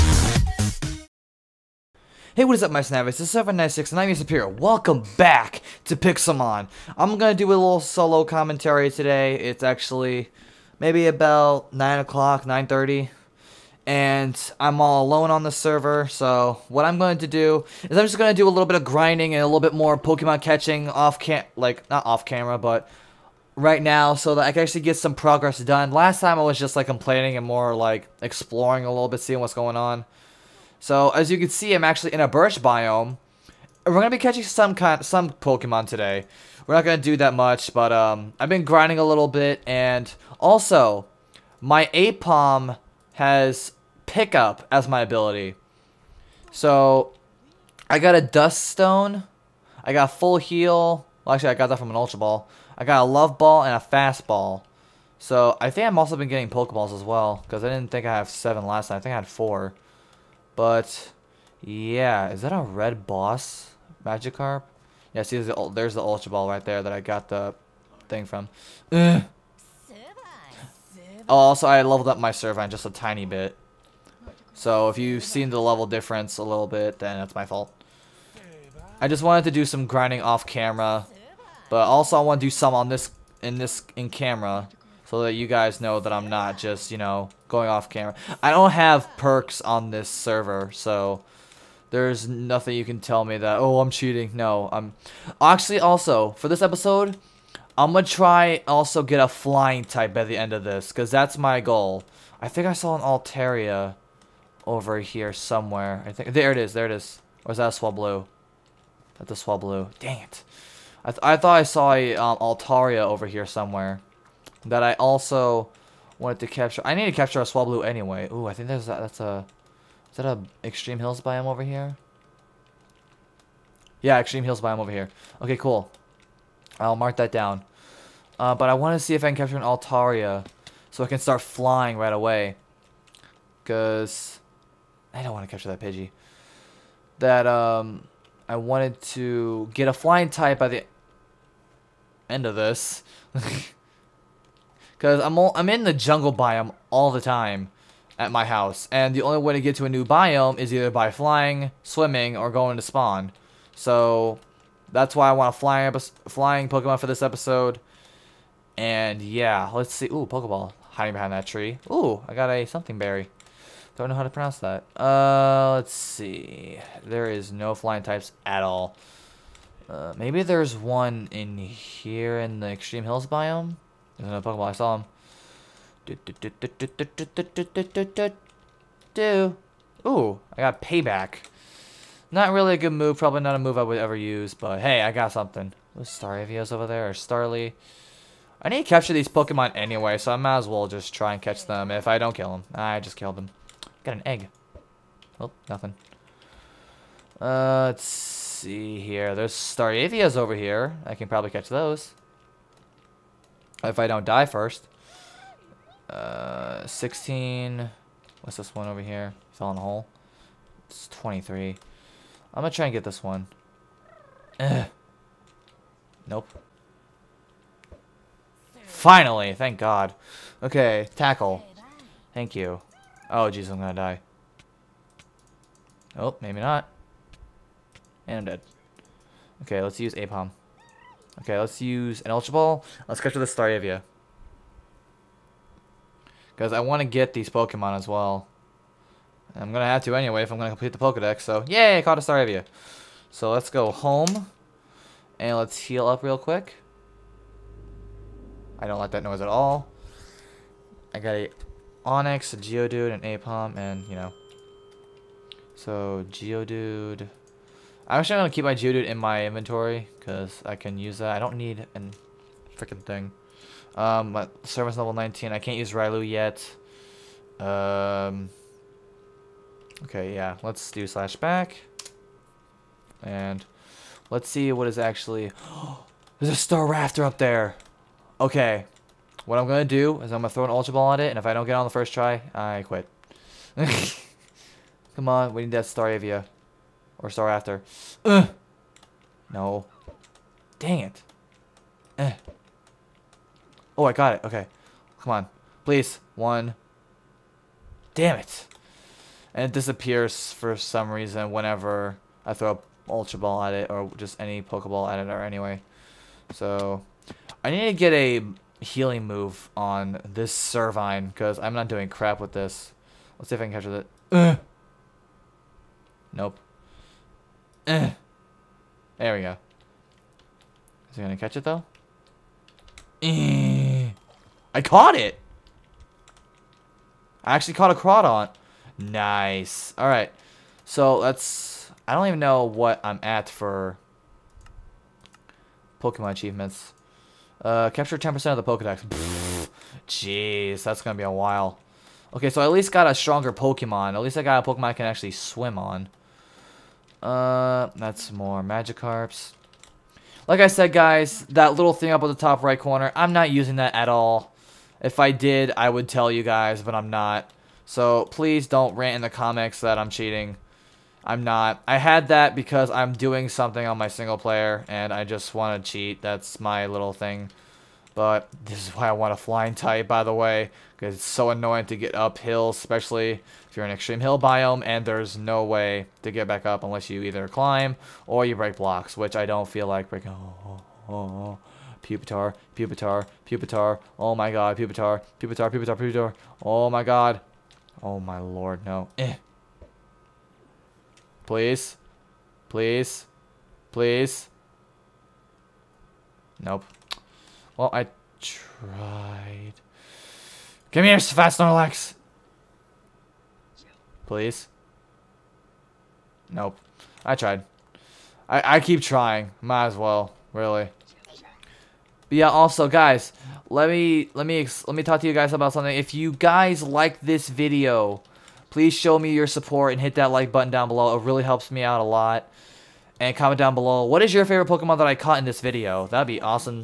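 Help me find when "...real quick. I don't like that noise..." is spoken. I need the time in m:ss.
4:06.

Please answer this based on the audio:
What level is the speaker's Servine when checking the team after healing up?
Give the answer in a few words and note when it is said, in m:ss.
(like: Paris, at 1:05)
19, at 4:24.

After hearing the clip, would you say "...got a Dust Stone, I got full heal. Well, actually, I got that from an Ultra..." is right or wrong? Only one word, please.
right.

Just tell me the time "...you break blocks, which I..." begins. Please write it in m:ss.
6:18.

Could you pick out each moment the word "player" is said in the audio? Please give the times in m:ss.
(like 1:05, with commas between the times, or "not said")
6:04.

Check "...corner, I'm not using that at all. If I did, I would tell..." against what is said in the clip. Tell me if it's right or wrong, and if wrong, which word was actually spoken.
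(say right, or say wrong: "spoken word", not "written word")
right.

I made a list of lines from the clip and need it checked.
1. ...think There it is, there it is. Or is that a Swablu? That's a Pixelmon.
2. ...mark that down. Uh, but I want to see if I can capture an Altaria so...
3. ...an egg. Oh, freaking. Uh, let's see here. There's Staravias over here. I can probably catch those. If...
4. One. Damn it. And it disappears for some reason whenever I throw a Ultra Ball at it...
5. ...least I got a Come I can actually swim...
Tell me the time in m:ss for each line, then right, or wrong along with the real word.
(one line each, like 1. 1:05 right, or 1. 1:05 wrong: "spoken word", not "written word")
1. 1:46 wrong: "Swablu", not "Pixelmon"
2. 2:06 right
3. 3:14 wrong: "nothing", not "freaking"
4. 4:56 right
5. 5:44 wrong: "Pokemon", not "Come".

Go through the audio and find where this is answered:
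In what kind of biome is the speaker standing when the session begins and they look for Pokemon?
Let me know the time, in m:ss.
0:32.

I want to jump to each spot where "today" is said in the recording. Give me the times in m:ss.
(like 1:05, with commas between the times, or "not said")
0:08, 0:35.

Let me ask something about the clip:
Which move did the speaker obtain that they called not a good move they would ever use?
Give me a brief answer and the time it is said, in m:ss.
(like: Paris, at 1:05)
Payback, at 3:00.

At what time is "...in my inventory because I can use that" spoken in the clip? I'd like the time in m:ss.
4:19.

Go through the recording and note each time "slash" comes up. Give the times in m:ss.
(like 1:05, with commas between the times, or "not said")
4:31.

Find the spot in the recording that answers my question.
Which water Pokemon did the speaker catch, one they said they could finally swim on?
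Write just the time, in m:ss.
5:27.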